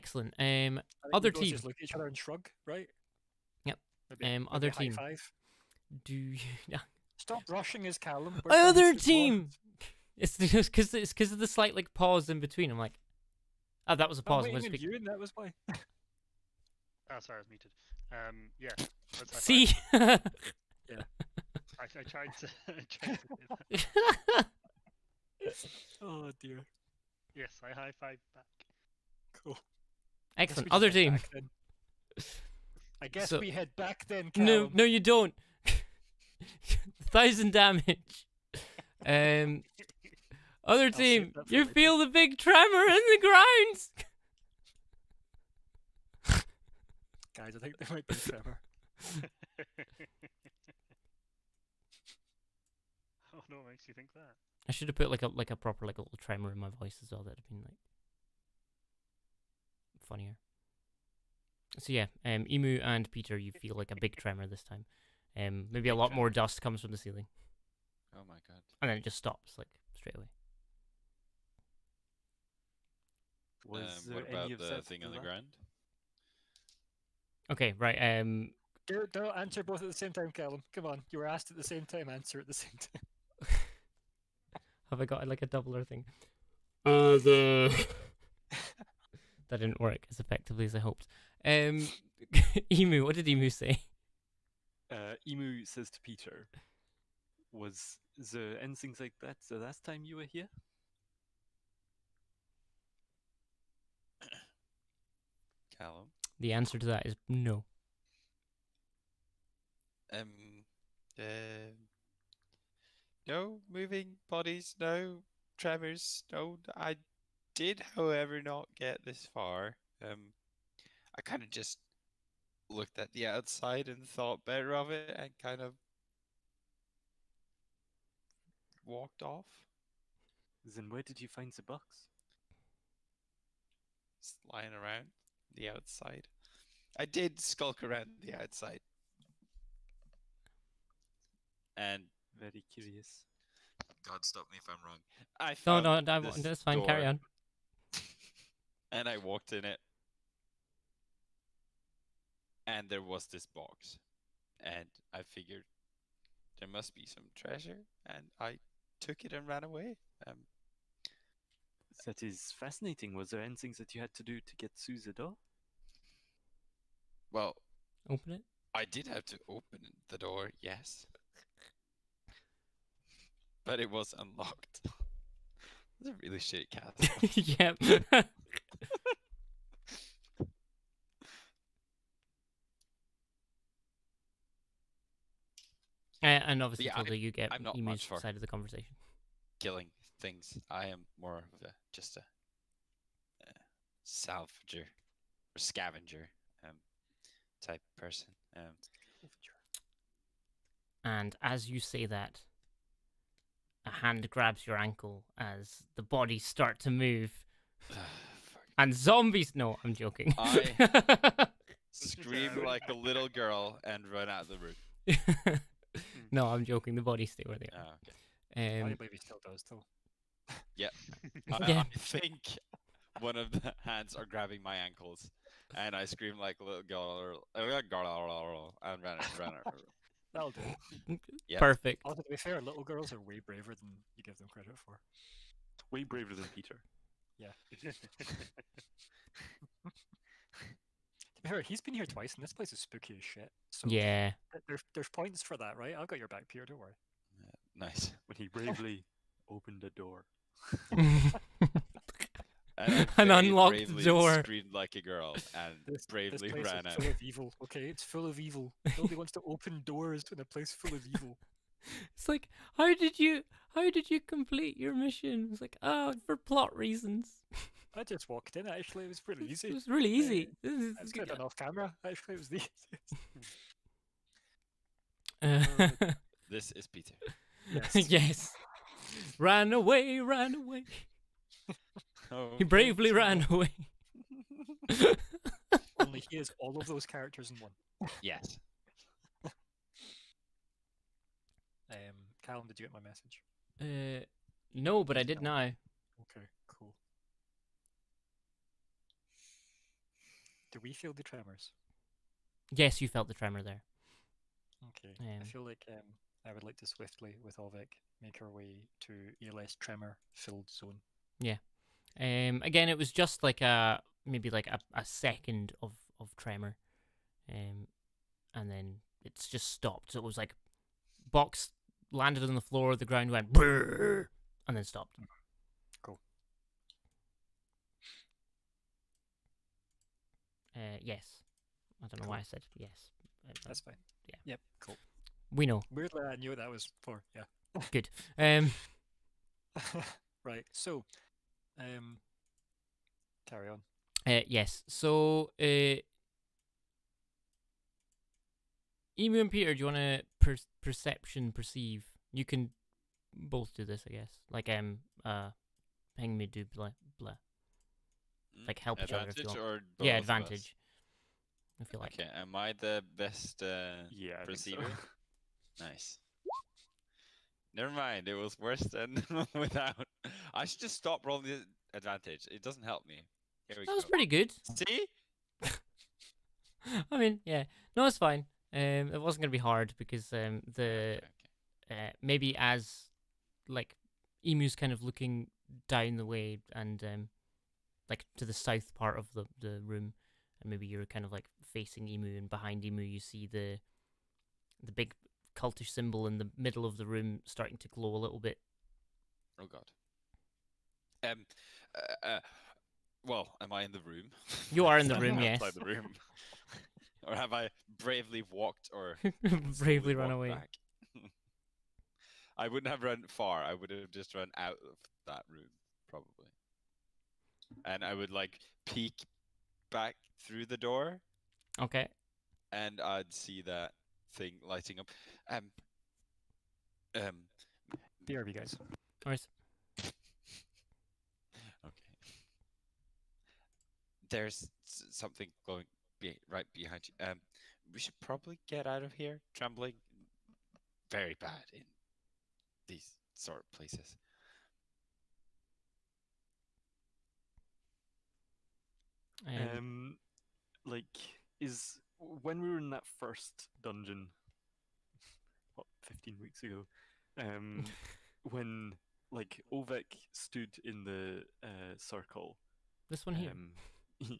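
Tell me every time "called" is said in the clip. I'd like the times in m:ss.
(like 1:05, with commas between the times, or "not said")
not said.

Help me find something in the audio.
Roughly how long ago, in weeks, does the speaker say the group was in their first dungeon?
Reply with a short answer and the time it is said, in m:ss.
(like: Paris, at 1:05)
15 weeks, at 7:36.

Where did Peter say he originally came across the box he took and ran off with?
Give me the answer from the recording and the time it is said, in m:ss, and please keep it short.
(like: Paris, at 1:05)
Lying around the outside, at 2:14.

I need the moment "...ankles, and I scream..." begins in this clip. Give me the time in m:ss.
3:44.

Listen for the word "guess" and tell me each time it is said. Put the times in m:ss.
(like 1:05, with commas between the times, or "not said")
0:33, 5:54.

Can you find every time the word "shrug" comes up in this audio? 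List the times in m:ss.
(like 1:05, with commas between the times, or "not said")
0:02.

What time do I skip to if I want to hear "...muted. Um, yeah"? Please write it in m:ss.
0:17.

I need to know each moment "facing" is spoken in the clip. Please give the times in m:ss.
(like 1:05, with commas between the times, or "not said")
6:31.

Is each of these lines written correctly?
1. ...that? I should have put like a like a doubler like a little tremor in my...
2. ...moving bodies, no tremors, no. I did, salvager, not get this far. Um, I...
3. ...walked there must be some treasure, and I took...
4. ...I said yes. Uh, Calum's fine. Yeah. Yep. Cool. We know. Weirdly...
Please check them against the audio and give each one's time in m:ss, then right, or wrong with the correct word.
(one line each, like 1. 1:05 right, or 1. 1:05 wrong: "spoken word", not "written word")
1. 0:54 wrong: "proper", not "doubler"
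2. 1:53 wrong: "however", not "salvager"
3. 2:35 wrong: "figured", not "walked"
4. 5:32 wrong: "That", not "Calum".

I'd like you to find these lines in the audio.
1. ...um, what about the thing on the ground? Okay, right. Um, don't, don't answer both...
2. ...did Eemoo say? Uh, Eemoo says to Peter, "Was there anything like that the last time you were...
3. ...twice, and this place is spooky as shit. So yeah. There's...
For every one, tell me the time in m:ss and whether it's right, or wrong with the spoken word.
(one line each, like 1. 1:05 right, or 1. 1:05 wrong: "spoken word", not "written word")
1. 1:14 right
2. 1:33 right
3. 4:02 right.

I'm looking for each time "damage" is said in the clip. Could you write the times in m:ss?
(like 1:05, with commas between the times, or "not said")
0:37.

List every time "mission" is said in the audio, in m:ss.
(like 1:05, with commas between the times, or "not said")
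4:24.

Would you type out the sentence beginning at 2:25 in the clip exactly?
I no, no, no that's fine.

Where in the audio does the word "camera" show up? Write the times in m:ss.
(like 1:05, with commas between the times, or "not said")
4:31.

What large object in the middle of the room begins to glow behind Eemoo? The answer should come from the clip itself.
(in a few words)
Cultish symbol.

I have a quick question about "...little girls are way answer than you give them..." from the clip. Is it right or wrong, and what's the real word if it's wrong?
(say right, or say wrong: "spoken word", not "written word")
wrong: "braver", not "answer".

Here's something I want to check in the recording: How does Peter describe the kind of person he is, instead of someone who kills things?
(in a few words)
A salvager or scavenger.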